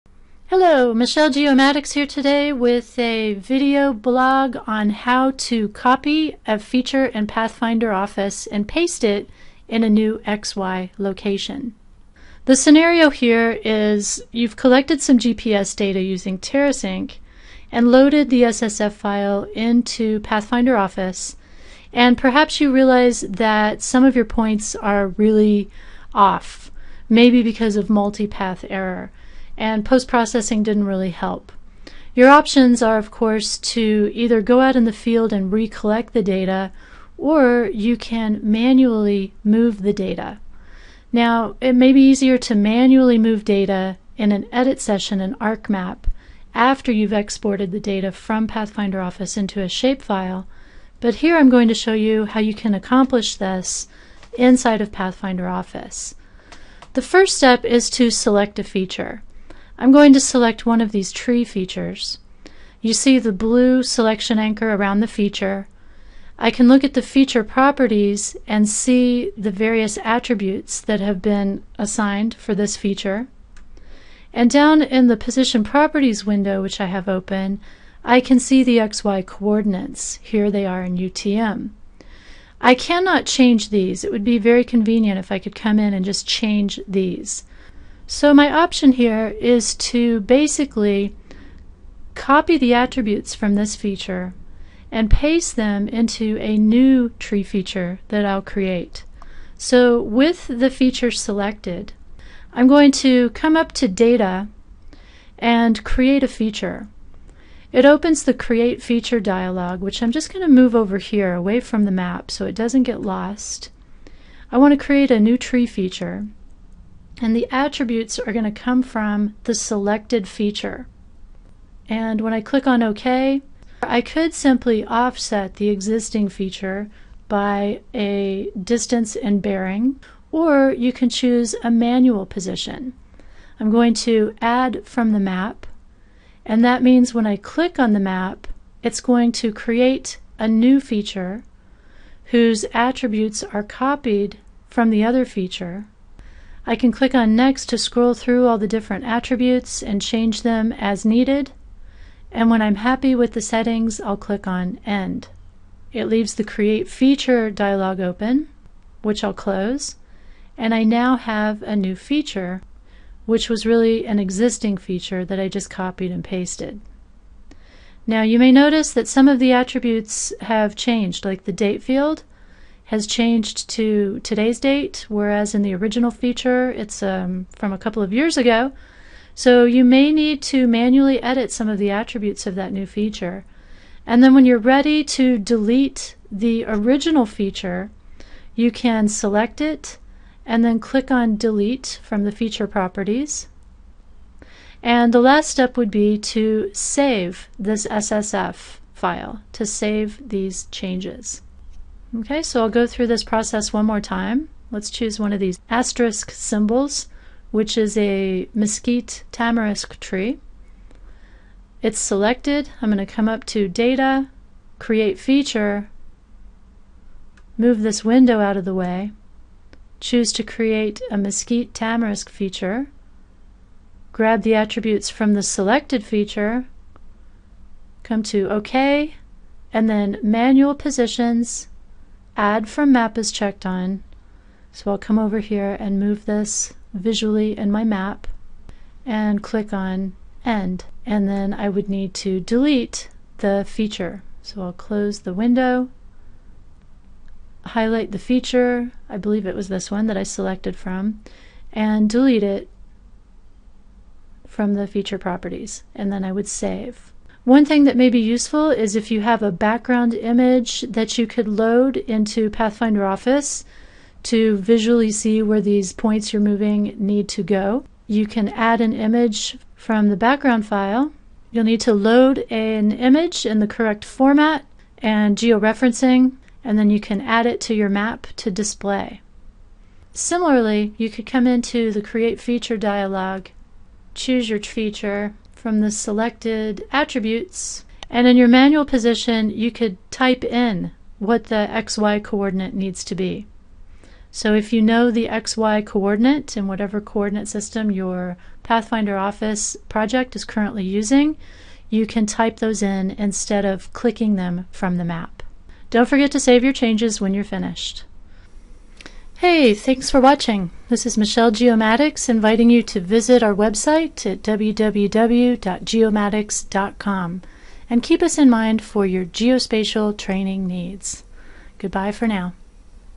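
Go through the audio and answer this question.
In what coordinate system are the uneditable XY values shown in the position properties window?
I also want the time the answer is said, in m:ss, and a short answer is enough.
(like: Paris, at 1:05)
UTM, at 1:20.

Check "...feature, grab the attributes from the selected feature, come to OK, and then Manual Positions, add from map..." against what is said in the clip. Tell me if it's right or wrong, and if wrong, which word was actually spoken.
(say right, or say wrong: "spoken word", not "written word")
right.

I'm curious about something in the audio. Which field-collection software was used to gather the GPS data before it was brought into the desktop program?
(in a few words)
TerraSync.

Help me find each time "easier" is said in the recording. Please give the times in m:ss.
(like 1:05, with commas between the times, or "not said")
0:42.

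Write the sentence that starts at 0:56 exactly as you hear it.
The first step is to select a feature.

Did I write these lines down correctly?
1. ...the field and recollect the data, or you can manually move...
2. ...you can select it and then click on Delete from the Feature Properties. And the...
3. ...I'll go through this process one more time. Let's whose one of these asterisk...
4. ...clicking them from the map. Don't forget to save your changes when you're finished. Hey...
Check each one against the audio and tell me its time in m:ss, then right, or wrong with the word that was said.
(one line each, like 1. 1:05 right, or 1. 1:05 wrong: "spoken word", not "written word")
1. 0:34 right
2. 3:08 right
3. 3:22 wrong: "choose", not "whose"
4. 5:03 right.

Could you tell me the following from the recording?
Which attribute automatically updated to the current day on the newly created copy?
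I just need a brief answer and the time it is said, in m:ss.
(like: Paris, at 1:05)
Date field, at 2:51.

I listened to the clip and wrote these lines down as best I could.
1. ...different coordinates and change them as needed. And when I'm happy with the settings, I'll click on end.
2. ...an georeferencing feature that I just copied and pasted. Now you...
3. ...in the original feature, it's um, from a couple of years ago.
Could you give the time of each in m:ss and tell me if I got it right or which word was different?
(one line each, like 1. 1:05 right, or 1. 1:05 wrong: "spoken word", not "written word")
1. 2:28 wrong: "attributes", not "coordinates"
2. 2:44 wrong: "existing", not "georeferencing"
3. 2:55 right.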